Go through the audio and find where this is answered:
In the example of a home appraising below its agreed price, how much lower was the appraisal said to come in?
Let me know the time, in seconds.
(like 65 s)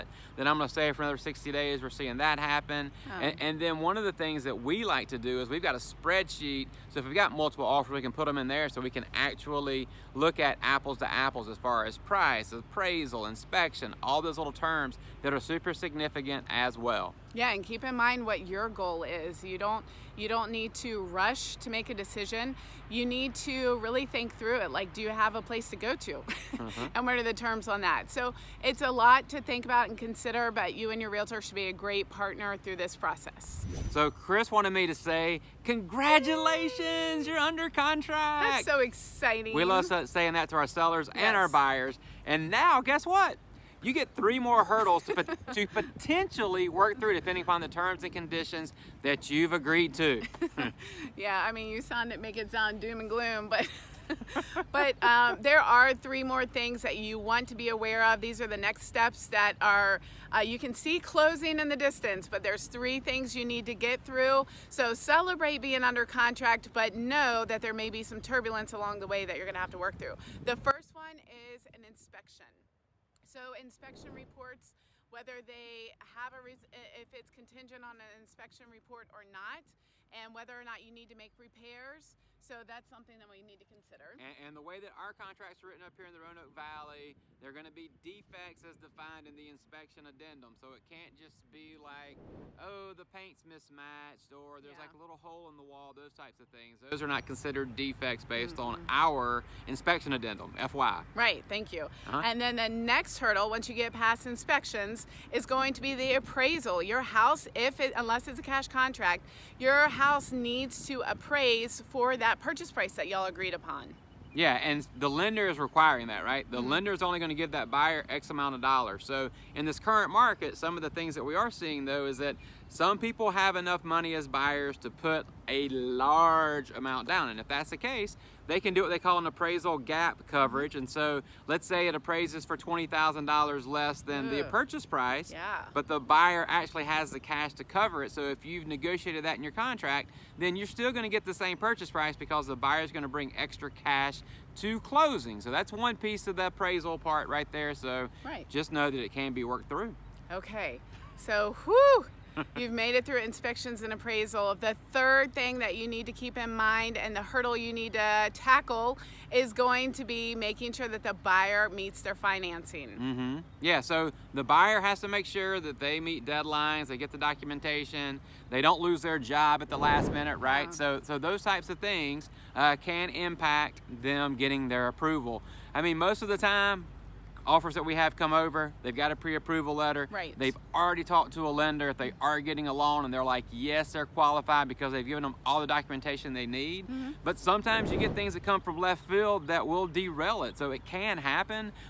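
132 s.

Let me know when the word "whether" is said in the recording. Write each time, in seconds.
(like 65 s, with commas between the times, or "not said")
75 s, 80 s.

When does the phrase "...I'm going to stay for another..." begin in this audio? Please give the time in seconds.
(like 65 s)
0 s.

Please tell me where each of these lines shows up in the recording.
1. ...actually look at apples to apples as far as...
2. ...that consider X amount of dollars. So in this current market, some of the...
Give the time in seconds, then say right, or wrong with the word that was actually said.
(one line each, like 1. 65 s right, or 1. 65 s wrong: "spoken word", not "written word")
1. 9 s right
2. 117 s wrong: "buyer", not "consider".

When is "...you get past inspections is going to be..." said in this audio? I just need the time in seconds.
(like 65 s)
103 s.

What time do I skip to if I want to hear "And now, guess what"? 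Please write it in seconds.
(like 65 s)
42 s.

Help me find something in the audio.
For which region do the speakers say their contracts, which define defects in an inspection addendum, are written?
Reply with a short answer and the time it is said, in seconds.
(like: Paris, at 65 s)
Roanoke Valley, at 86 s.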